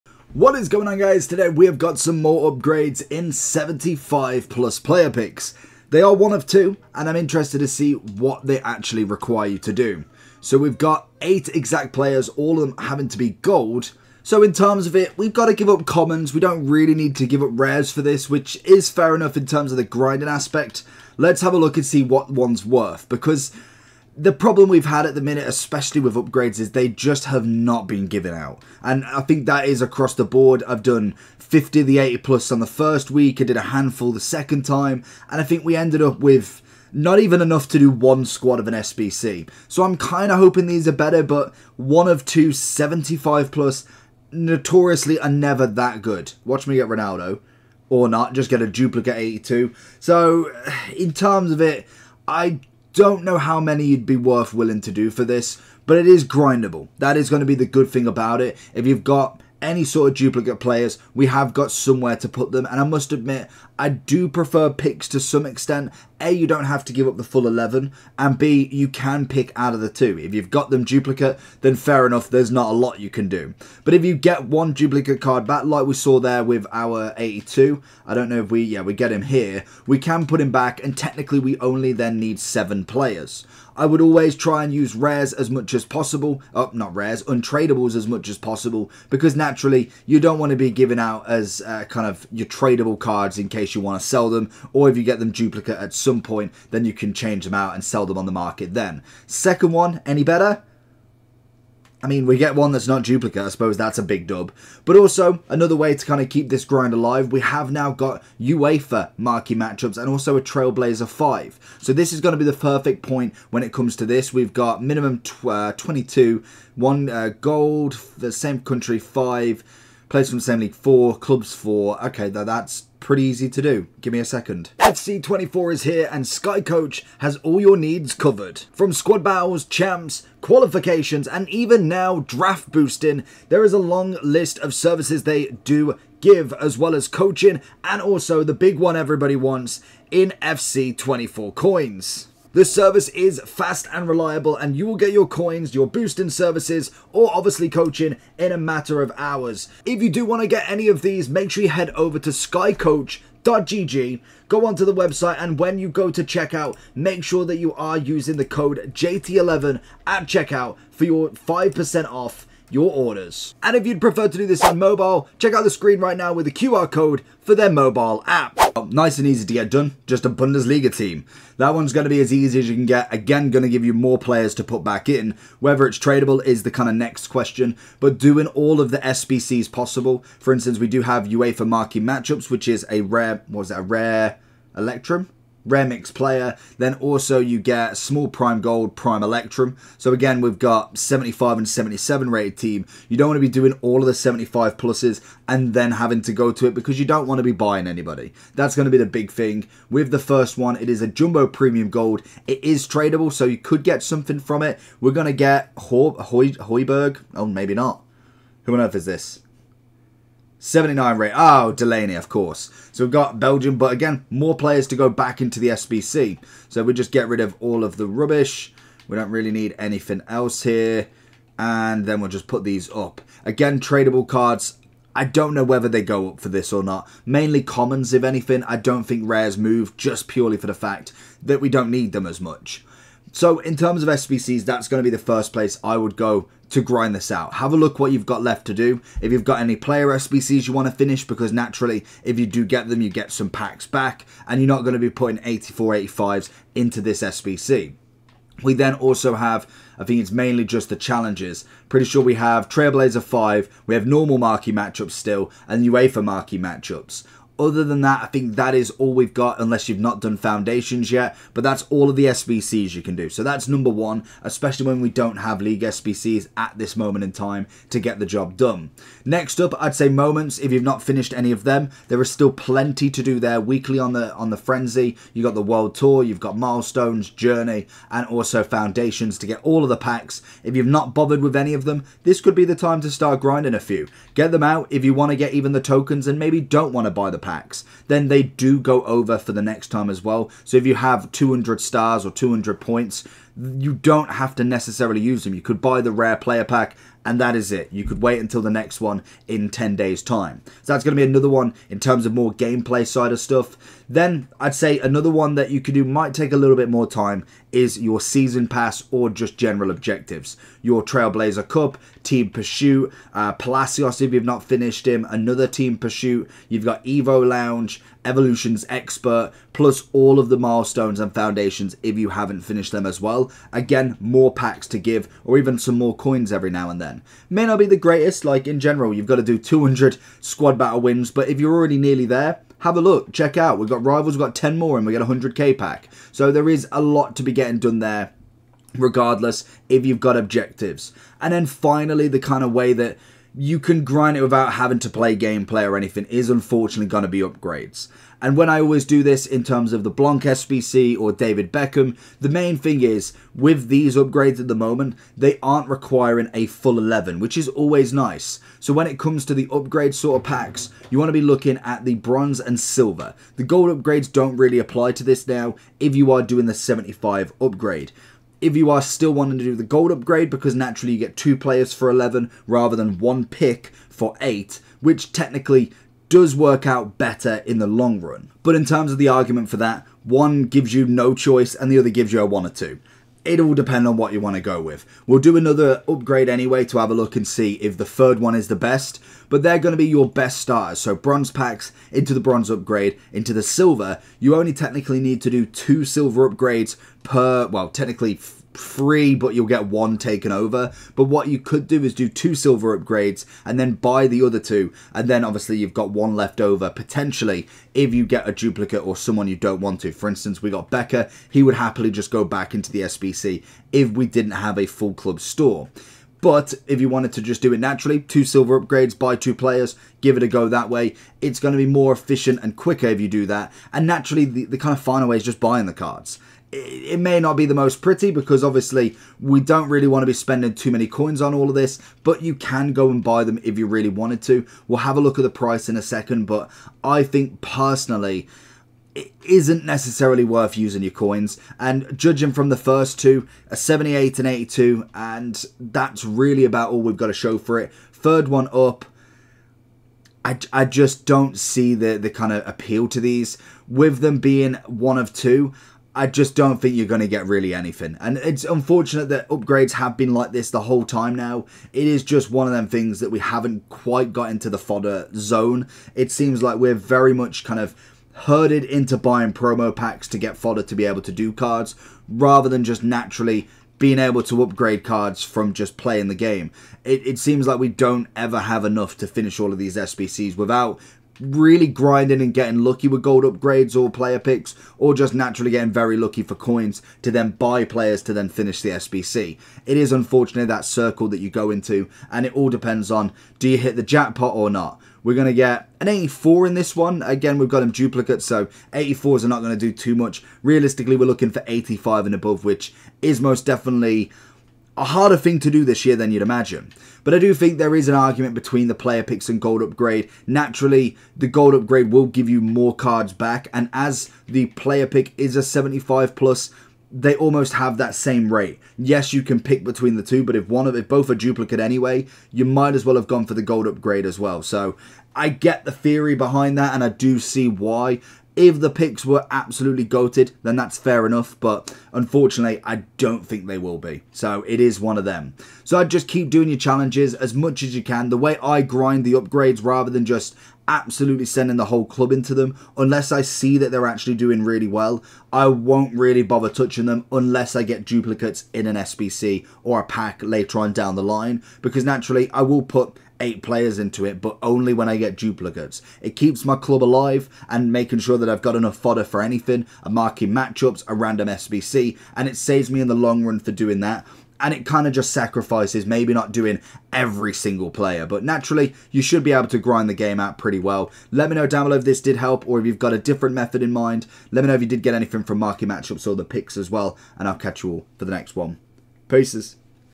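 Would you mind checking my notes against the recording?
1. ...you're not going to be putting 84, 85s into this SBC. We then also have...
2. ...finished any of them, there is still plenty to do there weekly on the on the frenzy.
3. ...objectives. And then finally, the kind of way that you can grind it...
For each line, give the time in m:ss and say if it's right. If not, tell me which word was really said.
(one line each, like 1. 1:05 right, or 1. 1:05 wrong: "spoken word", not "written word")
1. 4:04 right
2. 4:31 right
3. 5:40 right.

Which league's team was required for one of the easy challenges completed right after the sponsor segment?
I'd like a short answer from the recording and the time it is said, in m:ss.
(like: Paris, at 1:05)
Bundesliga, at 2:50.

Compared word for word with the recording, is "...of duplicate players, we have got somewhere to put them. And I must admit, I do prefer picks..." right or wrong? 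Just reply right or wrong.
right.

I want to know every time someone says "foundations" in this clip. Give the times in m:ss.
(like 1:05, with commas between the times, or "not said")
4:20, 4:38, 5:21.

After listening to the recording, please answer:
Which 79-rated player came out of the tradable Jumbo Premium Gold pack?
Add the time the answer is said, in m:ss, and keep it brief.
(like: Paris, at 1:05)
Delaney, at 3:31.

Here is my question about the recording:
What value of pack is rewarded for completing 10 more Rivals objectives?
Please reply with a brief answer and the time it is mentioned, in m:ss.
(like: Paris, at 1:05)
100k, at 5:35.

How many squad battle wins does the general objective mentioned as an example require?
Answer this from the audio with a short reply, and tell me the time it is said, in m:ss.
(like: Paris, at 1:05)
200, at 5:29.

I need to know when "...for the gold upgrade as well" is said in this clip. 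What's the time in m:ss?
8:43.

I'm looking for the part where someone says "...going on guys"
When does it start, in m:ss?
0:00.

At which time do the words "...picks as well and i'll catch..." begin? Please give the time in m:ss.
9:36.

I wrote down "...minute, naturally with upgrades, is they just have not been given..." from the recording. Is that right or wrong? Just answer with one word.
wrong.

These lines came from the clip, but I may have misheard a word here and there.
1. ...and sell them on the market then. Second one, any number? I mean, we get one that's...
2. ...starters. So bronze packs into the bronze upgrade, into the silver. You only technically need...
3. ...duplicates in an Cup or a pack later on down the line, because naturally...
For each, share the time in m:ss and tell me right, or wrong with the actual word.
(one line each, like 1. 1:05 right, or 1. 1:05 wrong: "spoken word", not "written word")
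1. 1:37 wrong: "better", not "number"
2. 6:30 right
3. 9:08 wrong: "SBC", not "Cup".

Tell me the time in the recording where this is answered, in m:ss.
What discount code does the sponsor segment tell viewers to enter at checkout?
2:38.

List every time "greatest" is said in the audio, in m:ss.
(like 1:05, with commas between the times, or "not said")
5:27.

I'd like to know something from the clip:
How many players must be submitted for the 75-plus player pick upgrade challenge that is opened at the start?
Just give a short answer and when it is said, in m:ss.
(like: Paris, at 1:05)
8, at 0:11.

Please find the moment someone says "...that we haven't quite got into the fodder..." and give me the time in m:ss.
7:43.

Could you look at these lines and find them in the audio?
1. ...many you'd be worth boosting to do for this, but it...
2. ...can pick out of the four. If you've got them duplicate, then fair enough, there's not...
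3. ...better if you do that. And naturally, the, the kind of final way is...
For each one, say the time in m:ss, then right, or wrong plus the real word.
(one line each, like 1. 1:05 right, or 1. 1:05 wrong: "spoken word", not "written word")
1. 0:53 wrong: "willing", not "boosting"
2. 1:08 wrong: "two", not "four"
3. 7:02 wrong: "quicker", not "better".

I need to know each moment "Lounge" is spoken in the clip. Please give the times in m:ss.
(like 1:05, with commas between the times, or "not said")
5:17.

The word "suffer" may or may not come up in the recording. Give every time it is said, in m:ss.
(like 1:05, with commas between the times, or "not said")
not said.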